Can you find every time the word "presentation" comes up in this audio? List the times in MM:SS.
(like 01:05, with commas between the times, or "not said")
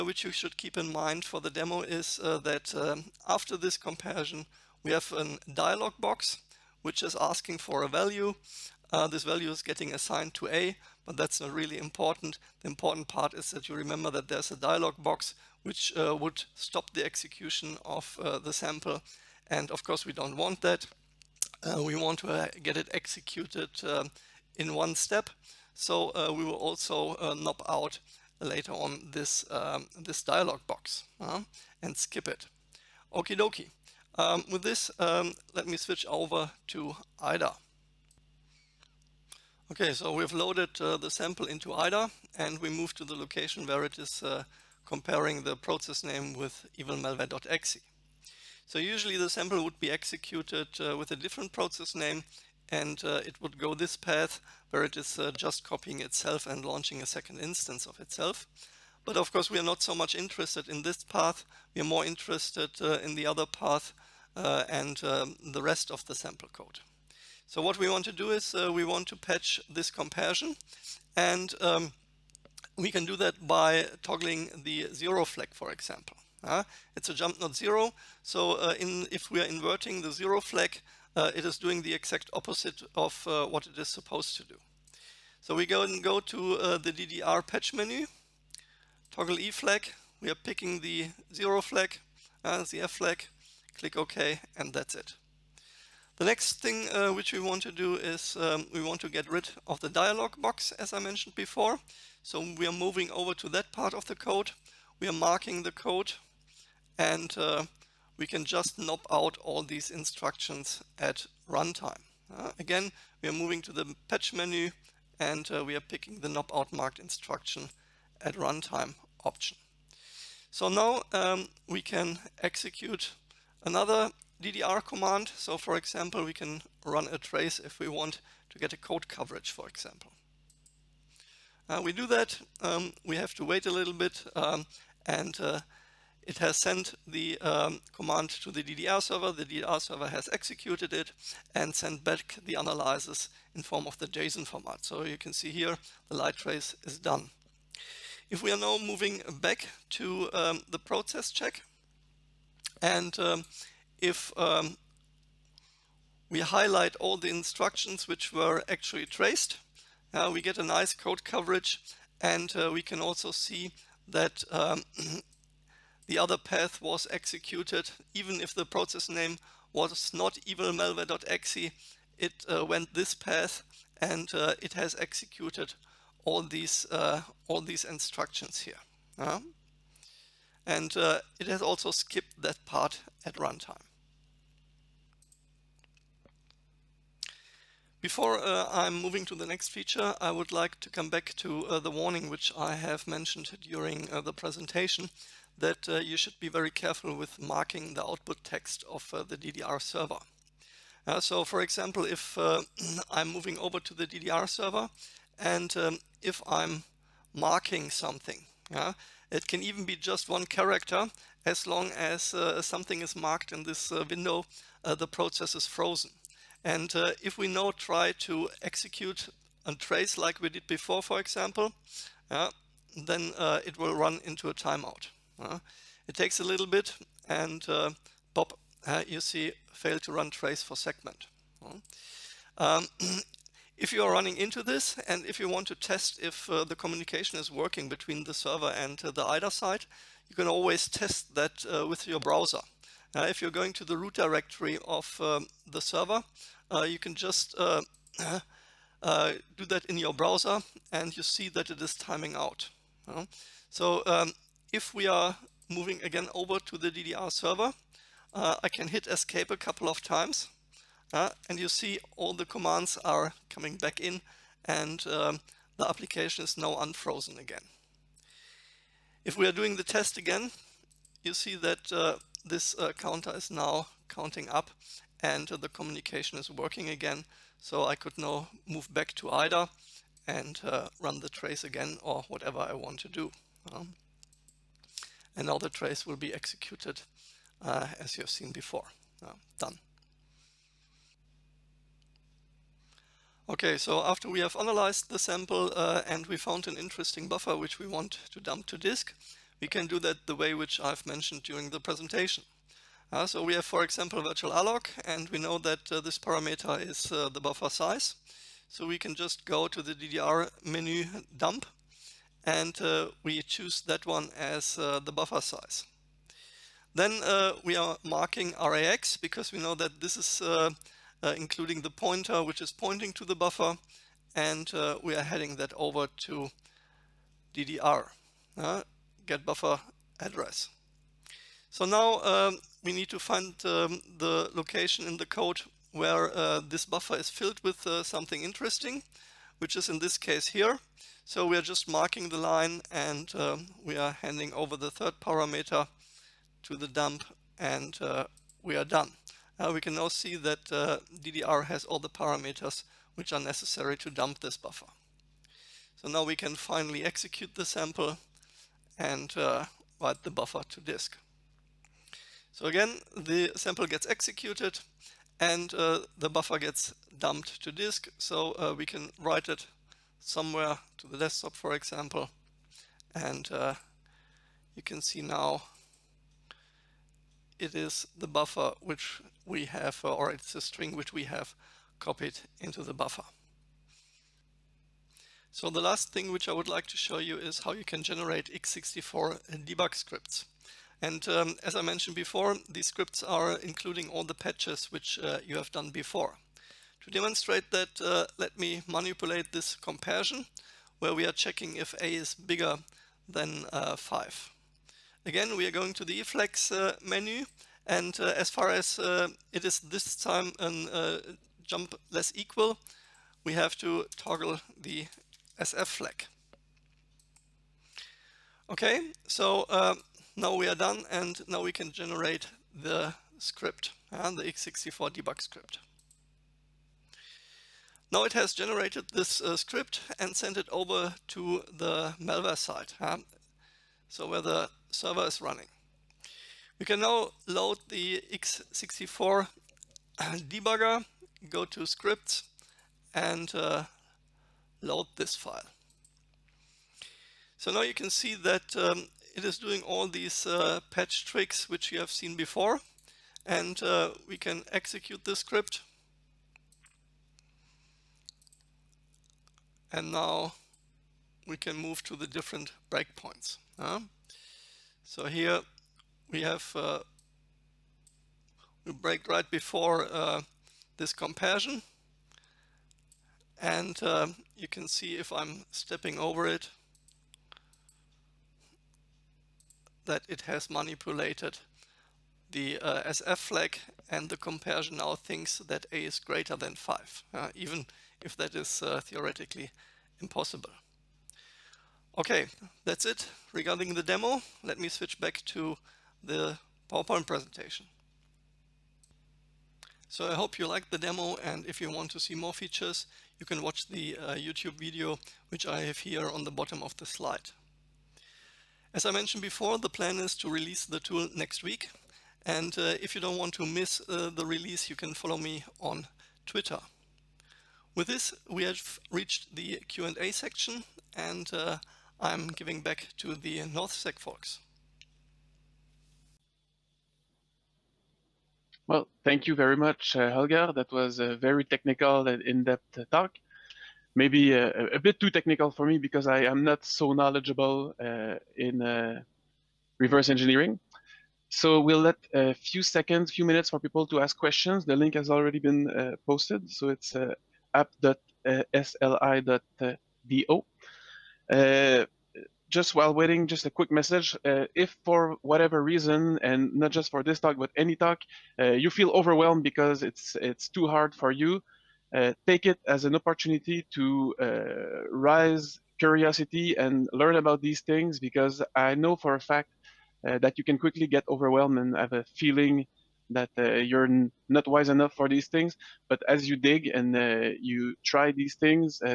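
03:14, 05:01, 08:17.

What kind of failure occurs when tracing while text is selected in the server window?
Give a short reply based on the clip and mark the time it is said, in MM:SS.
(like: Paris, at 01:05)
timeout, at 03:44.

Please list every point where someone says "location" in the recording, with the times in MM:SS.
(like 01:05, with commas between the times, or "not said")
00:43, 05:34.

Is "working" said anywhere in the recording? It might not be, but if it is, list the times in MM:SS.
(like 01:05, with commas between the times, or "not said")
03:57, 04:36.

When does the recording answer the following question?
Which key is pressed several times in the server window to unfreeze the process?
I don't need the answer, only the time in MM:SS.
04:19.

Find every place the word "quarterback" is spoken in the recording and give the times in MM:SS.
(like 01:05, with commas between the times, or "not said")
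not said.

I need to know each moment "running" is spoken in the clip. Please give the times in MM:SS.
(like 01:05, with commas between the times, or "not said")
03:54, 07:15.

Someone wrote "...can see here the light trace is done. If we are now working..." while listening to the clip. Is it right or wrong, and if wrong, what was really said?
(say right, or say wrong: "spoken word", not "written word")
wrong: "moving", not "working".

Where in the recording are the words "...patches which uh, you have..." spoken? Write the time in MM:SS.
06:34.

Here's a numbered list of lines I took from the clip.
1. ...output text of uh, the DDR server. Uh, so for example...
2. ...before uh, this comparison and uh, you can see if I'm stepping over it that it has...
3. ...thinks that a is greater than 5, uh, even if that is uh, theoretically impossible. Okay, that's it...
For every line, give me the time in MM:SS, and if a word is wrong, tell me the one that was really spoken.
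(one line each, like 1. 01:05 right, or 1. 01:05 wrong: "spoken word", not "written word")
1. 03:18 right
2. 07:49 right
3. 08:05 right.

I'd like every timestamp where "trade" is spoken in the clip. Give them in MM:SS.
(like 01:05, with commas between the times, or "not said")
not said.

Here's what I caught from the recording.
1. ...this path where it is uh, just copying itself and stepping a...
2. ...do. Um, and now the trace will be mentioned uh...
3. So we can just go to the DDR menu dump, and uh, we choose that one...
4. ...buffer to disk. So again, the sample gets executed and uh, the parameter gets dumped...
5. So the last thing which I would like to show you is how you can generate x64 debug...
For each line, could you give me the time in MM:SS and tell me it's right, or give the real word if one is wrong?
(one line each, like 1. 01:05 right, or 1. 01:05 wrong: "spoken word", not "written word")
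1. 00:53 wrong: "launching", not "stepping"
2. 04:43 wrong: "executed", not "mentioned"
3. 05:08 right
4. 06:00 wrong: "buffer", not "parameter"
5. 06:25 right.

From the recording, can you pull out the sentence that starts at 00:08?
Uh, this value is getting assigned to A, but that's not really important.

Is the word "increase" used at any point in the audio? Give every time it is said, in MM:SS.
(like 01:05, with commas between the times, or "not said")
not said.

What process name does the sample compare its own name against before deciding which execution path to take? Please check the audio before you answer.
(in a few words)
evilmalware.exe.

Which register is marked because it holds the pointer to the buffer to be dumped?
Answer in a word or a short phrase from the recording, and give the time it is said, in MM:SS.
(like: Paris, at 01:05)
RAX, at 05:18.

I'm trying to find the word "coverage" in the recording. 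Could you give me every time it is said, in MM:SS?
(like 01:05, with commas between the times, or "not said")
02:09, 02:41.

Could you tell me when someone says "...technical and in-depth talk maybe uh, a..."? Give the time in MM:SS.
08:51.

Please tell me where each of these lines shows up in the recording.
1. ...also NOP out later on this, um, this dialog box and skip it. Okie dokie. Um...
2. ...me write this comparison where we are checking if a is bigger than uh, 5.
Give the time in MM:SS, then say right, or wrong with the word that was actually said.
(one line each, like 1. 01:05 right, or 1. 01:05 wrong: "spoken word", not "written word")
1. 00:26 right
2. 06:38 wrong: "manipulate", not "write".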